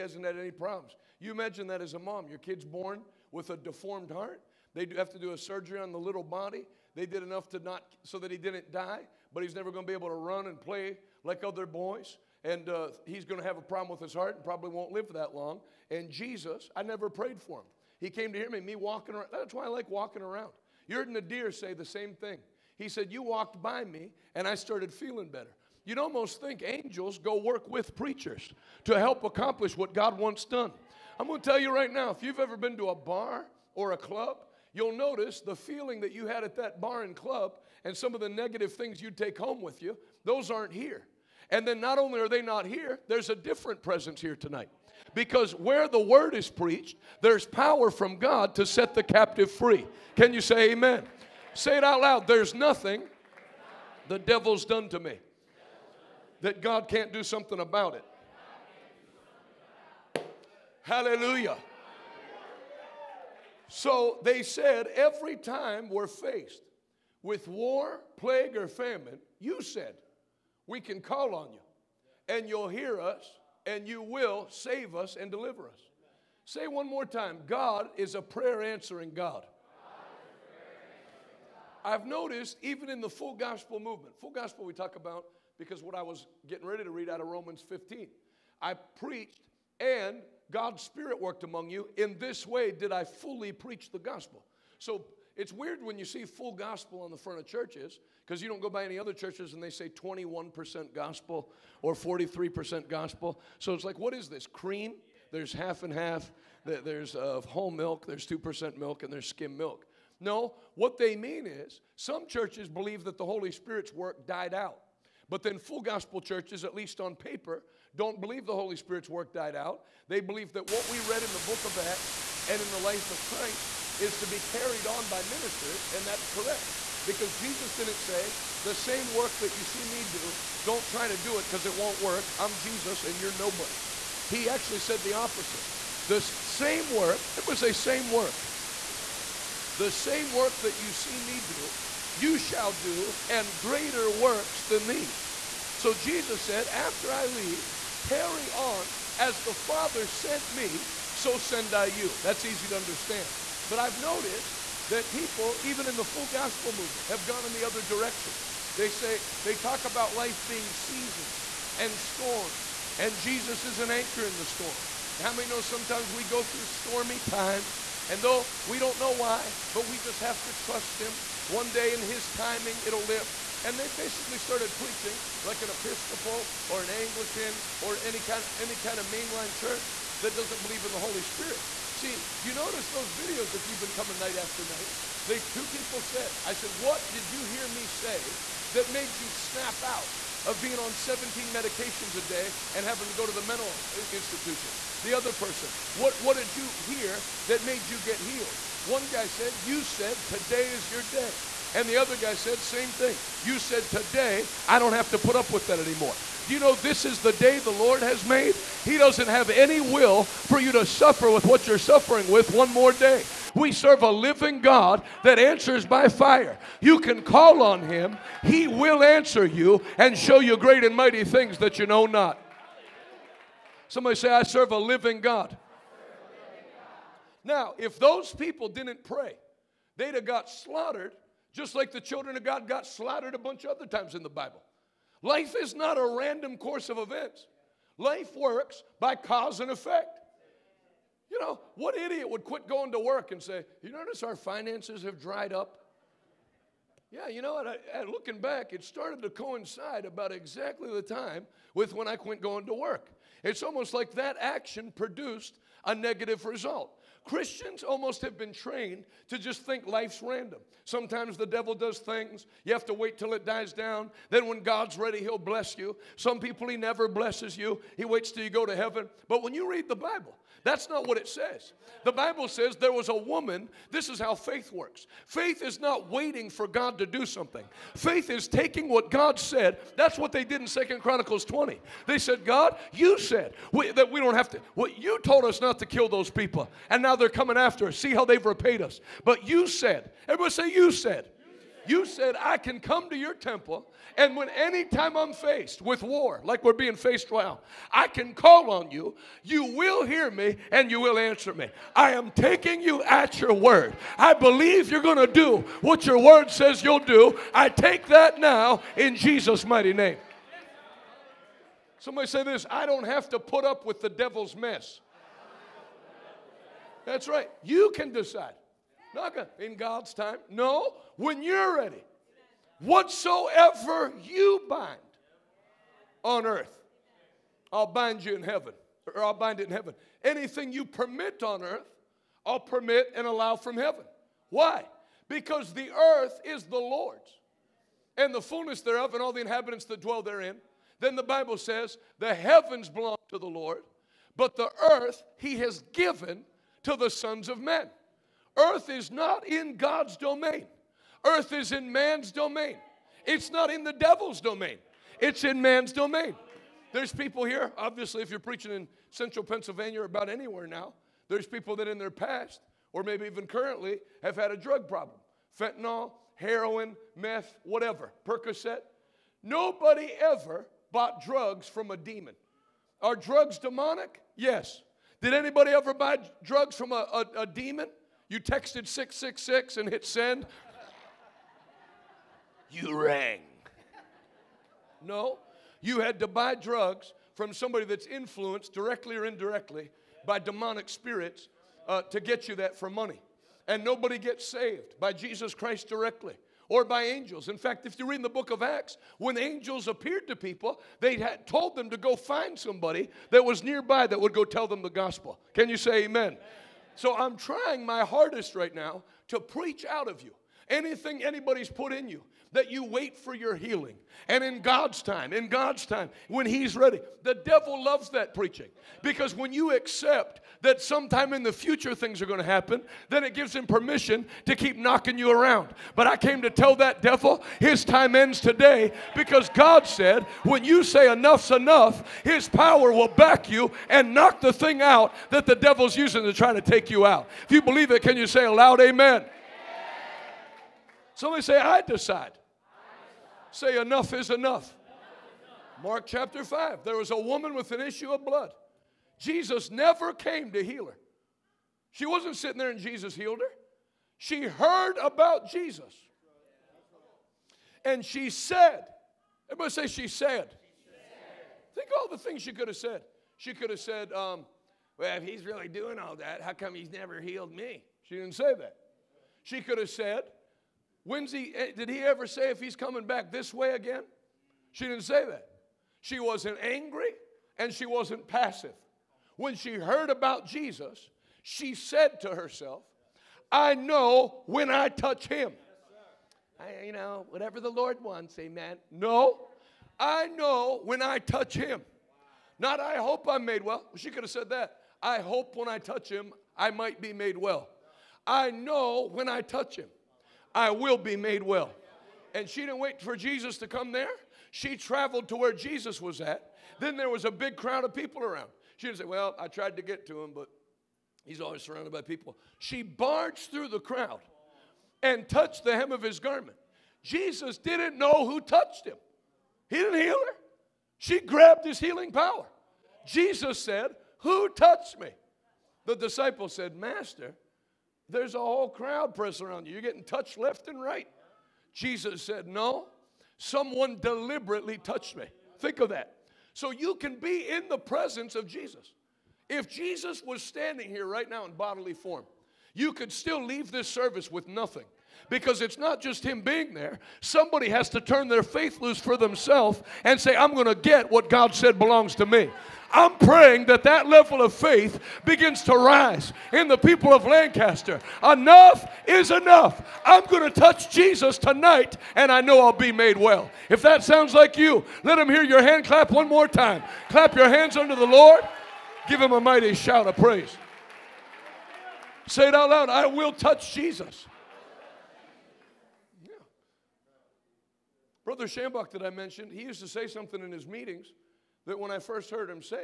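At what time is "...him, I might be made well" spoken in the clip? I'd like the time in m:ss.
8:16.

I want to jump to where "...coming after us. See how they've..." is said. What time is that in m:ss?
4:47.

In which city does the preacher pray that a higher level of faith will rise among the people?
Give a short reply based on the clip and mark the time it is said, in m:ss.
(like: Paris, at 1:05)
Lancaster, at 9:17.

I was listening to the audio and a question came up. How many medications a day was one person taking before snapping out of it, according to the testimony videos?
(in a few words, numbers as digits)
17.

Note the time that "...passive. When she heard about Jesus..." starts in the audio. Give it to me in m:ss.
7:58.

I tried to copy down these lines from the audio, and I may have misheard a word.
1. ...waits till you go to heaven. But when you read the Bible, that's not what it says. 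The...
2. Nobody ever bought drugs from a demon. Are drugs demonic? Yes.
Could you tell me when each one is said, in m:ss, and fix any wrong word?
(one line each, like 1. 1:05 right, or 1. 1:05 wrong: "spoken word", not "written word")
1. 4:28 right
2. 6:09 right.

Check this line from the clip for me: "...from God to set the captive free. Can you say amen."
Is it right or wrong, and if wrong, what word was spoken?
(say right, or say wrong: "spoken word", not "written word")
right.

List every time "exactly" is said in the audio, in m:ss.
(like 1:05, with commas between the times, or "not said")
4:10.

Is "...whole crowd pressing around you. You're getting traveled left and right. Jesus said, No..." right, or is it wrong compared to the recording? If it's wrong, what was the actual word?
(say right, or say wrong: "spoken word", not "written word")
wrong: "touched", not "traveled".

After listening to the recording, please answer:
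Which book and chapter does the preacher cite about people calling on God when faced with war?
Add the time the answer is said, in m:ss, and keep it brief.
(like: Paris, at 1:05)
Second Chronicles 20, at 4:40.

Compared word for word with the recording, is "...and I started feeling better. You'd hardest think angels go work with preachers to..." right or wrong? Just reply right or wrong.
wrong.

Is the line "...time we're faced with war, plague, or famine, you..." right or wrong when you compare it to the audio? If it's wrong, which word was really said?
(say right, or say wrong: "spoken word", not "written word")
right.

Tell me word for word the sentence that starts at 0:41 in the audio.
And then not only are they not here, there's a different presence here tonight.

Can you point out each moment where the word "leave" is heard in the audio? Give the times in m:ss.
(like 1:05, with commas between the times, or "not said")
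2:27, 9:03.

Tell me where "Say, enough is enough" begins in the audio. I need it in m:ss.
7:23.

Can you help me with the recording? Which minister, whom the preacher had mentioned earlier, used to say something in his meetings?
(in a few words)
Brother Shambach.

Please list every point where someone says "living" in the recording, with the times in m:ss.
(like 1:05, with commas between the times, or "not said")
3:34, 3:44.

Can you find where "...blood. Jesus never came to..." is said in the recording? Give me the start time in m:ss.
7:28.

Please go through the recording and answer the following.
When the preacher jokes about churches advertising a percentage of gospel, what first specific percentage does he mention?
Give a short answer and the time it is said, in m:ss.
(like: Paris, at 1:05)
21%, at 1:39.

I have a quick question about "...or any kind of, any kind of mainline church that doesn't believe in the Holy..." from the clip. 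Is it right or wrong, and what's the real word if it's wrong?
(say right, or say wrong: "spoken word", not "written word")
right.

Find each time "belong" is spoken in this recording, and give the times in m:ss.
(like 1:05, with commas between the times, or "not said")
5:42, 9:11.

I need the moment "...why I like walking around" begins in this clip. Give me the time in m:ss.
0:19.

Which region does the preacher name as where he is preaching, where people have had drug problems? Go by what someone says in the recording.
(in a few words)
central Pennsylvania.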